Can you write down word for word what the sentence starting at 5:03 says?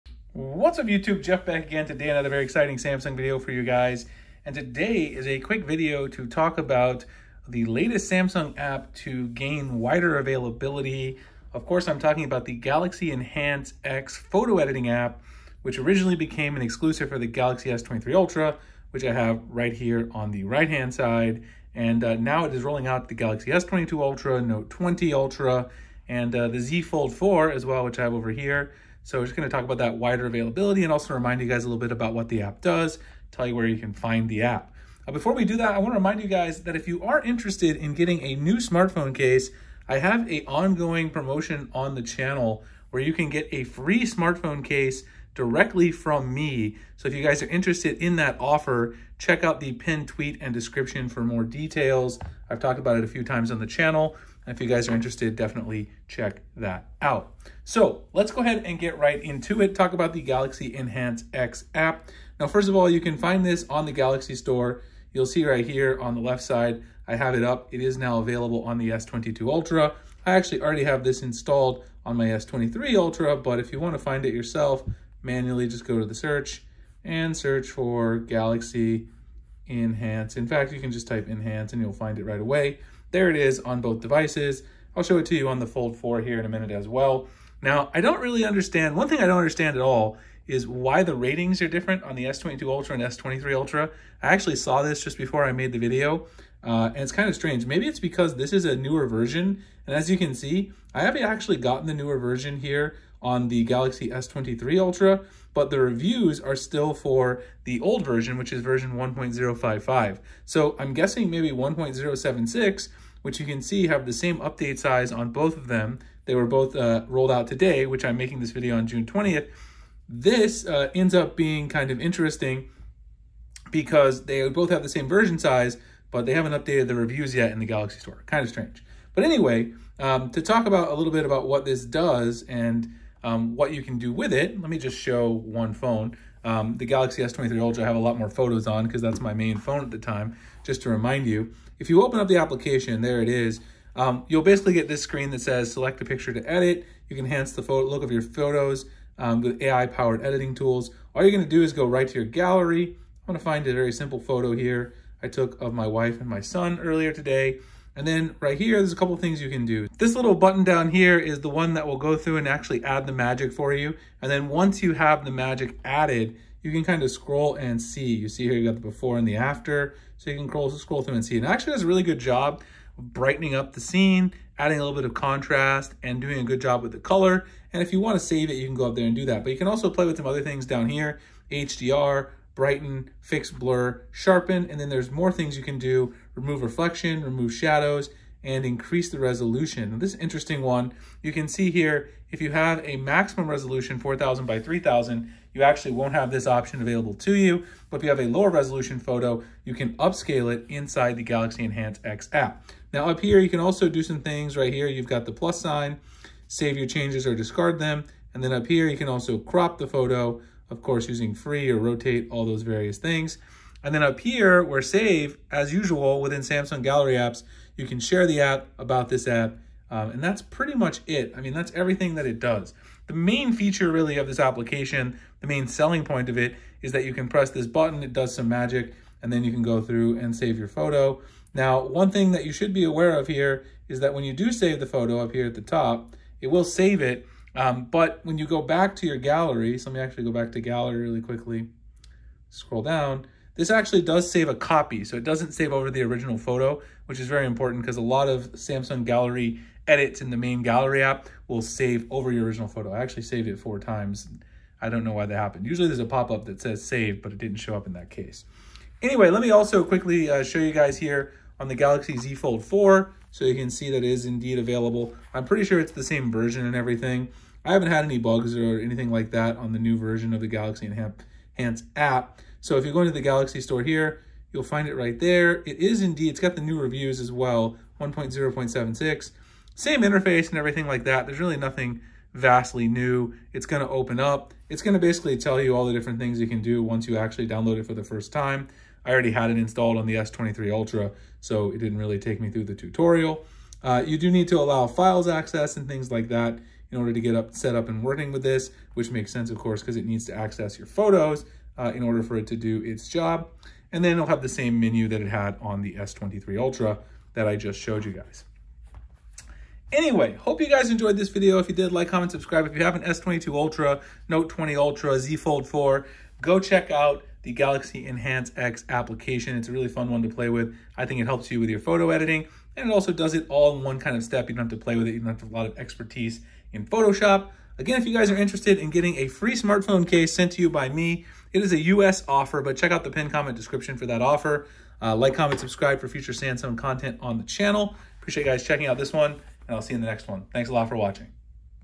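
And then it'll have the same menu that it had on the S23 Ultra that I just showed you guys.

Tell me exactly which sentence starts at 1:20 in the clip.
In fact, you can just type Enhance and you'll find it right away.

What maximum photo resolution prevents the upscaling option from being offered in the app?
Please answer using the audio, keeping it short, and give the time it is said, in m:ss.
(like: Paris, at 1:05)
4000 by 3000, at 3:13.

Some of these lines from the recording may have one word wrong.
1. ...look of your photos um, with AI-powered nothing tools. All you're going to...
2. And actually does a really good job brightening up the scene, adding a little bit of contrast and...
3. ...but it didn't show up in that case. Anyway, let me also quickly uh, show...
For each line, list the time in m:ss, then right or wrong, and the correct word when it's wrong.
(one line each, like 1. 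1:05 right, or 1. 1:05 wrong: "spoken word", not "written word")
1. 2:27 wrong: "editing", not "nothing"
2. 2:51 right
3. 4:17 right.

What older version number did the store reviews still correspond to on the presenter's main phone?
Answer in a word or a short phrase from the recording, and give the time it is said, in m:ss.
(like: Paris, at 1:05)
1.055, at 1:48.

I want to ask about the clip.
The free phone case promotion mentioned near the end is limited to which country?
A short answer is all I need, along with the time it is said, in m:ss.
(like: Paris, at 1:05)
US, at 5:31.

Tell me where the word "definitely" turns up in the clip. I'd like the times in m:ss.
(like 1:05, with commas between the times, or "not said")
0:55.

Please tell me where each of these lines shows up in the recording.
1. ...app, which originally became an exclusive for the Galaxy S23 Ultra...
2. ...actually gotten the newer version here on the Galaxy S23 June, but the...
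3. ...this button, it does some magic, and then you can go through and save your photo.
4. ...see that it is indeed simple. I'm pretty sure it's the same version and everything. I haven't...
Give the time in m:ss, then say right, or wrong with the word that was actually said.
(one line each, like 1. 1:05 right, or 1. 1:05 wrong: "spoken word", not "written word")
1. 0:14 right
2. 1:41 wrong: "Ultra", not "June"
3. 3:47 right
4. 4:23 wrong: "available", not "simple".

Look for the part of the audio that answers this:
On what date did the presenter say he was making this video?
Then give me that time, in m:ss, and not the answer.
1:58.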